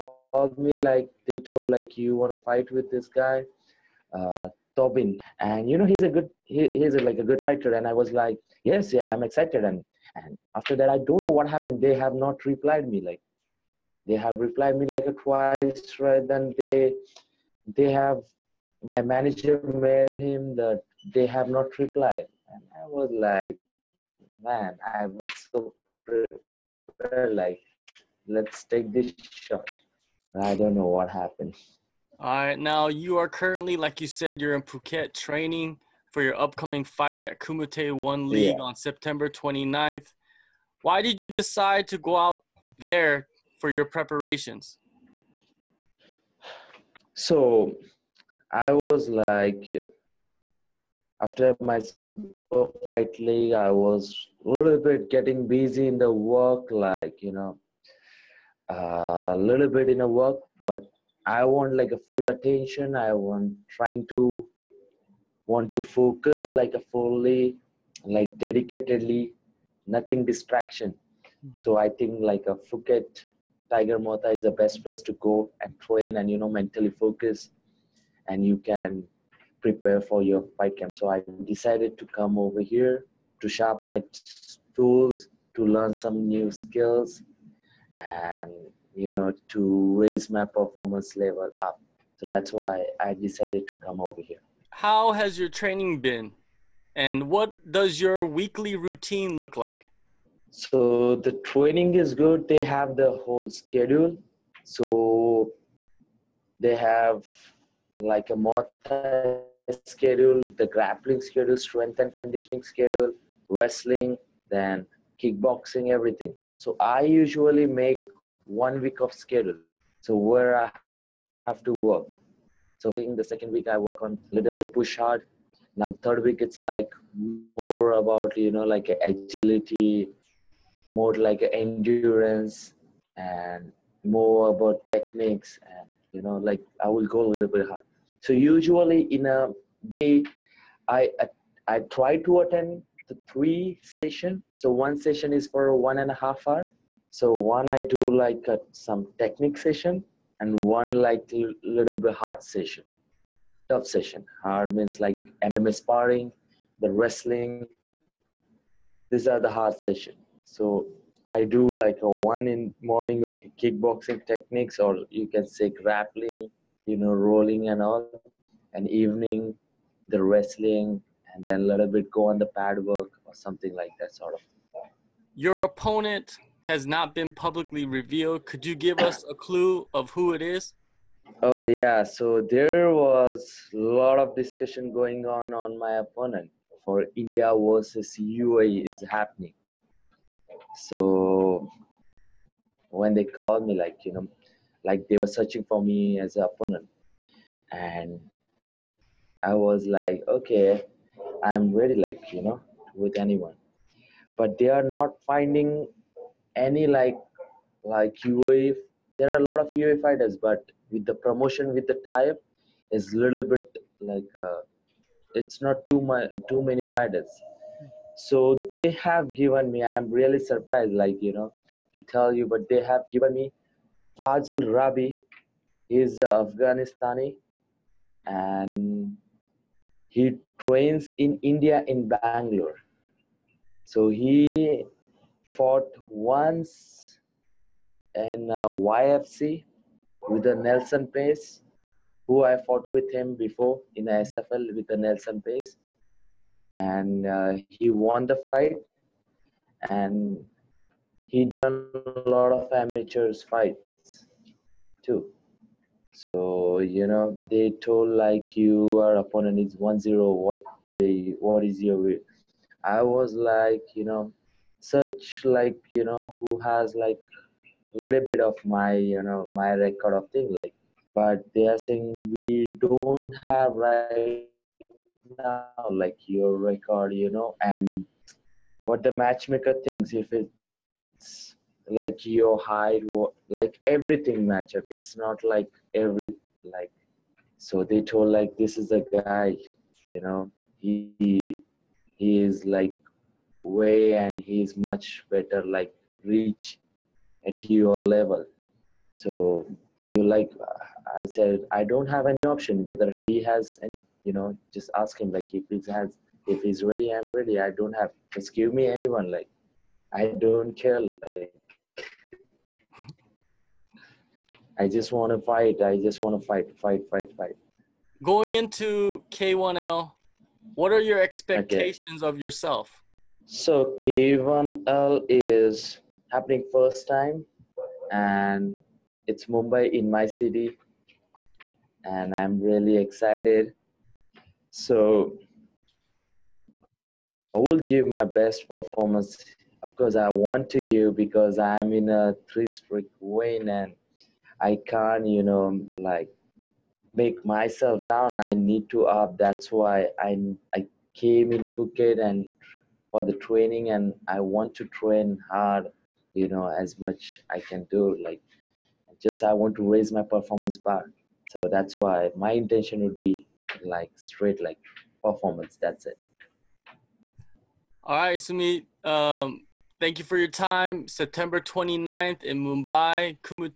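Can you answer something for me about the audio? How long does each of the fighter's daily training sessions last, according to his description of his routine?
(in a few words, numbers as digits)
1.5 hours.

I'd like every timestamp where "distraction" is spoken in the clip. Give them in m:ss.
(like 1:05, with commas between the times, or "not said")
1:10.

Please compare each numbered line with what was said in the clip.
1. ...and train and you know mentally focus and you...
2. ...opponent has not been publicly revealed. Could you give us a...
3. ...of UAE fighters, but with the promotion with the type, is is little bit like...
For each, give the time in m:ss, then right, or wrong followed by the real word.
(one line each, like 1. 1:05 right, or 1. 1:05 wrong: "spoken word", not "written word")
1. 1:15 right
2. 2:55 right
3. 3:29 right.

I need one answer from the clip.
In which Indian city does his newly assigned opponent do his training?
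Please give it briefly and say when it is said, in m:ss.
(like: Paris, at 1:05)
Bangalore, at 3:52.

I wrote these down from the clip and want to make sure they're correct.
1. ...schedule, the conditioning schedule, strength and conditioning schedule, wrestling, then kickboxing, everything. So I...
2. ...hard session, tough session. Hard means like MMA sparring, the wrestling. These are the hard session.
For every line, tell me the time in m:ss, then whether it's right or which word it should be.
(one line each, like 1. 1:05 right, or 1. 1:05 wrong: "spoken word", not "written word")
1. 1:49 wrong: "grappling", not "conditioning"
2. 2:32 right.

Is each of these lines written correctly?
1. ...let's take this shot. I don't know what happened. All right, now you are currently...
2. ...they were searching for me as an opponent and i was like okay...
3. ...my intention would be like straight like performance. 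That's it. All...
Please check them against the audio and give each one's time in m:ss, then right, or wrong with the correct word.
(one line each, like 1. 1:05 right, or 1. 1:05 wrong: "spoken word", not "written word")
1. 0:28 right
2. 3:15 right
3. 6:02 right.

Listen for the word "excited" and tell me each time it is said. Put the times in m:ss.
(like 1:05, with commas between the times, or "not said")
0:09, 5:32.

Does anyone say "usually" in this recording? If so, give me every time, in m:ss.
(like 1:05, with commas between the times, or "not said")
1:57, 2:18.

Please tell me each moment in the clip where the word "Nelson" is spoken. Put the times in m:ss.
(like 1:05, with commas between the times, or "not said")
4:00, 4:04.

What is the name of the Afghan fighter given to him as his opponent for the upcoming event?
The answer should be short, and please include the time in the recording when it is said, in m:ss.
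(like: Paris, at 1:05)
Fazal Rabi, at 3:44.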